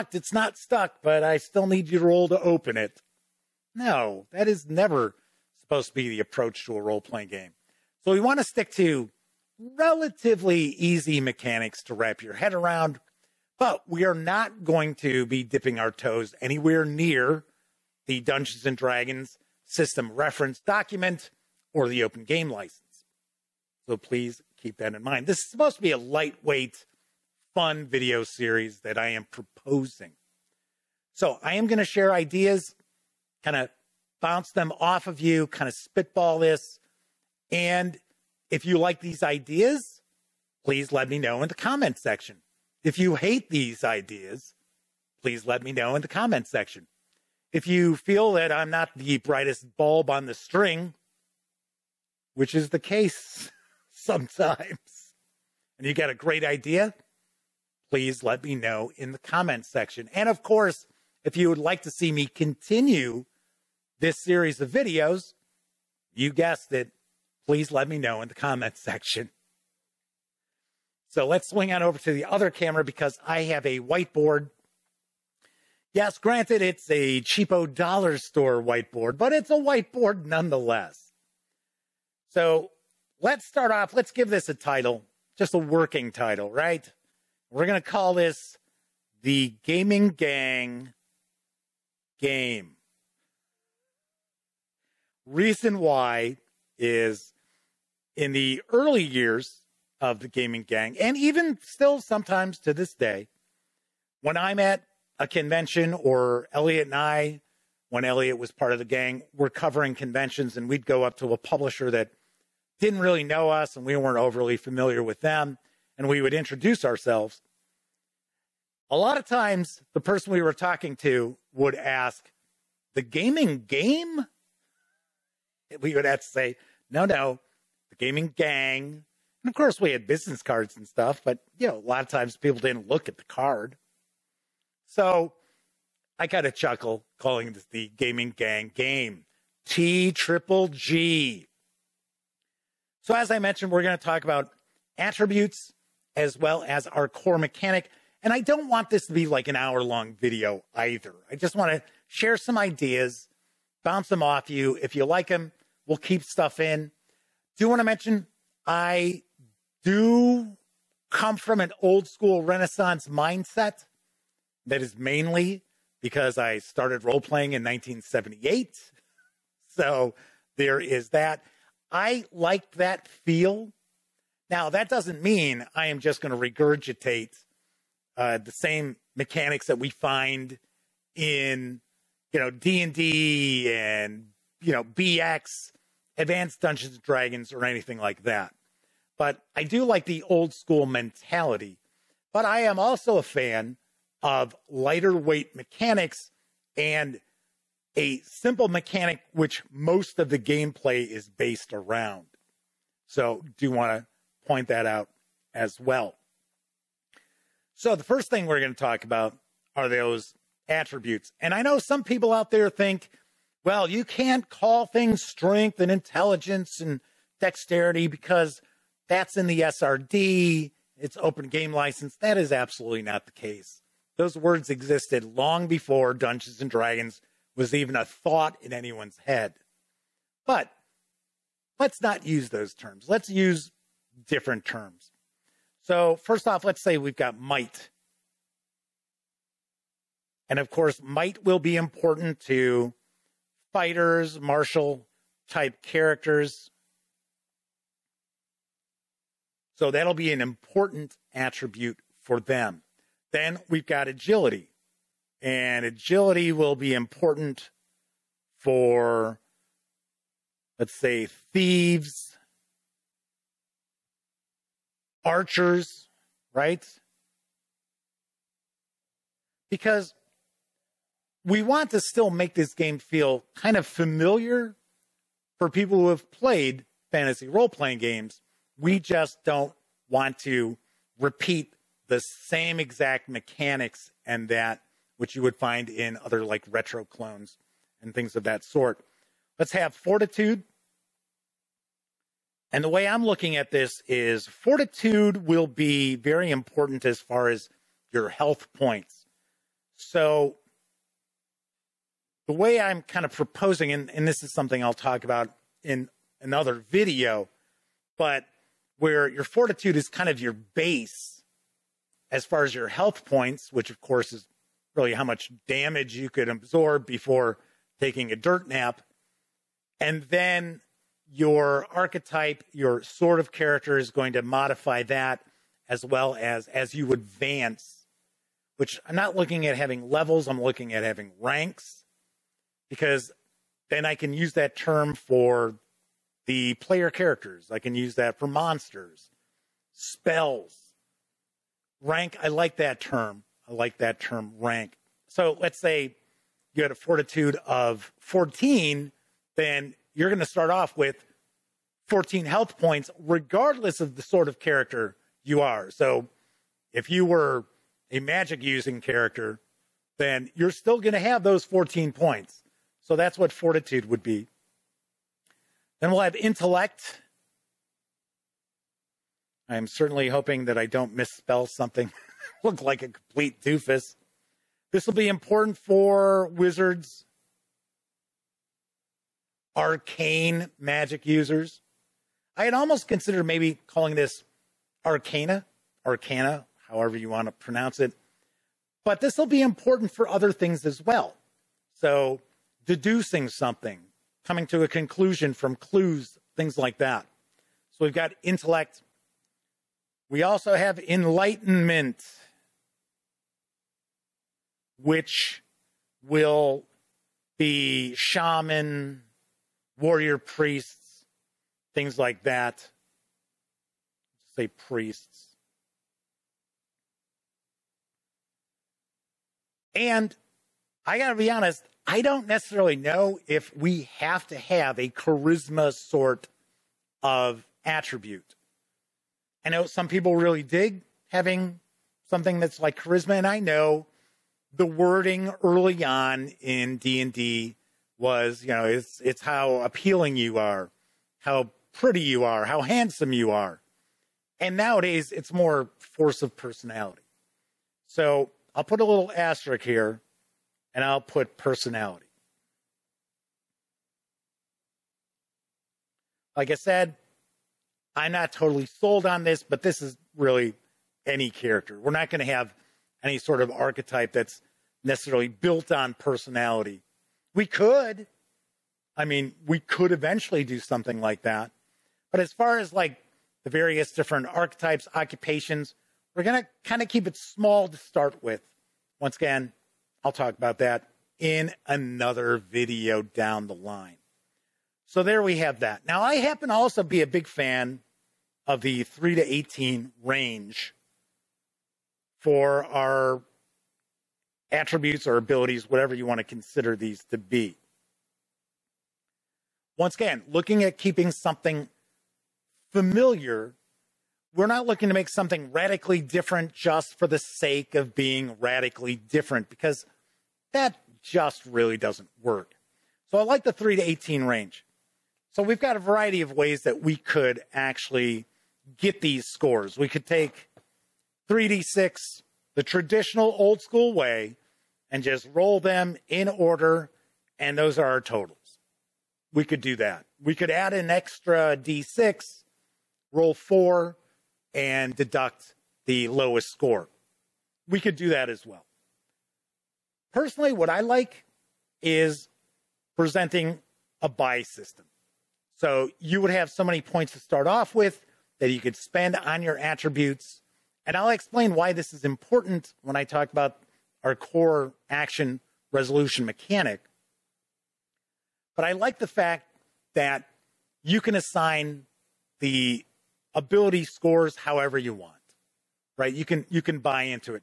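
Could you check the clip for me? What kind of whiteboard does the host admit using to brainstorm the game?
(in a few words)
Dollar store whiteboard.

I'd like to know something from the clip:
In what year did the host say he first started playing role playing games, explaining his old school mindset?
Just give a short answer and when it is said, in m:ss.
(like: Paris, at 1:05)
1978, at 2:47.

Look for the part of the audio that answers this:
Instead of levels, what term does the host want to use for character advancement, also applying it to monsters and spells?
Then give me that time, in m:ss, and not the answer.
5:31.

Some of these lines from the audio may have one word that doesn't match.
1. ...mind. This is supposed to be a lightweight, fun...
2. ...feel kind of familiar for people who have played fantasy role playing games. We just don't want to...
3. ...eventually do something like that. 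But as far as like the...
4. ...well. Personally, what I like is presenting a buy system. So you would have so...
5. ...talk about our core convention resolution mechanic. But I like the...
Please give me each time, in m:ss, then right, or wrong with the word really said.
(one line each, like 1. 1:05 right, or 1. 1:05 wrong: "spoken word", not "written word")
1. 0:25 right
2. 4:32 right
3. 7:50 right
4. 8:58 right
5. 9:13 wrong: "action", not "convention".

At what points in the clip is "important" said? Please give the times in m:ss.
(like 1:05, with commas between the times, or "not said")
4:01, 4:10, 4:16, 4:56, 6:15, 6:29, 9:12.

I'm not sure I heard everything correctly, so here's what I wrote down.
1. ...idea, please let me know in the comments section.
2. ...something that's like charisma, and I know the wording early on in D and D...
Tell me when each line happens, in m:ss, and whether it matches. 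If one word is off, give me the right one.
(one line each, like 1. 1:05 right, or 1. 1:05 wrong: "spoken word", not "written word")
1. 0:56 right
2. 7:12 right.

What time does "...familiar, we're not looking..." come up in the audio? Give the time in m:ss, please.
8:22.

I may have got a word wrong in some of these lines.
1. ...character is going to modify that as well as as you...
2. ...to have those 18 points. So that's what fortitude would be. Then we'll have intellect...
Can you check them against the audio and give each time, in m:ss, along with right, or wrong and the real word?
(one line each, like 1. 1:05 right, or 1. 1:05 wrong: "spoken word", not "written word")
1. 5:23 right
2. 6:01 wrong: "14", not "18".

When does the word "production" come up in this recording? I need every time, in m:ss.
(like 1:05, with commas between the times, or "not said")
not said.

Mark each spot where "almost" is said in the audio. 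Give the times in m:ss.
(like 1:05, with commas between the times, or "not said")
6:22.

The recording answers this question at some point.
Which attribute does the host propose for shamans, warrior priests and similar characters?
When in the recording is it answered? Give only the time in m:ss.
6:40.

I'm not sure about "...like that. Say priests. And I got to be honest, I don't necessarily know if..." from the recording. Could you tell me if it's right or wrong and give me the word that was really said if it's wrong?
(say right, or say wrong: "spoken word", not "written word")
right.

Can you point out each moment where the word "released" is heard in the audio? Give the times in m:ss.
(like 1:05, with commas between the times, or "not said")
not said.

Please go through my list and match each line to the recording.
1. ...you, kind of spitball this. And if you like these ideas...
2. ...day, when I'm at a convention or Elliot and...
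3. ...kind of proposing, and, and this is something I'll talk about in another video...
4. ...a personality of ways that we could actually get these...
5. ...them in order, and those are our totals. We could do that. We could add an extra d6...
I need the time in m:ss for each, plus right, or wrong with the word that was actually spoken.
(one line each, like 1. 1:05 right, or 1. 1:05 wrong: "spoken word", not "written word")
1. 0:35 right
2. 1:42 right
3. 5:03 right
4. 8:35 wrong: "variety", not "personality"
5. 8:45 right.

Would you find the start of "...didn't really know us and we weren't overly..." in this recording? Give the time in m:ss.
1:52.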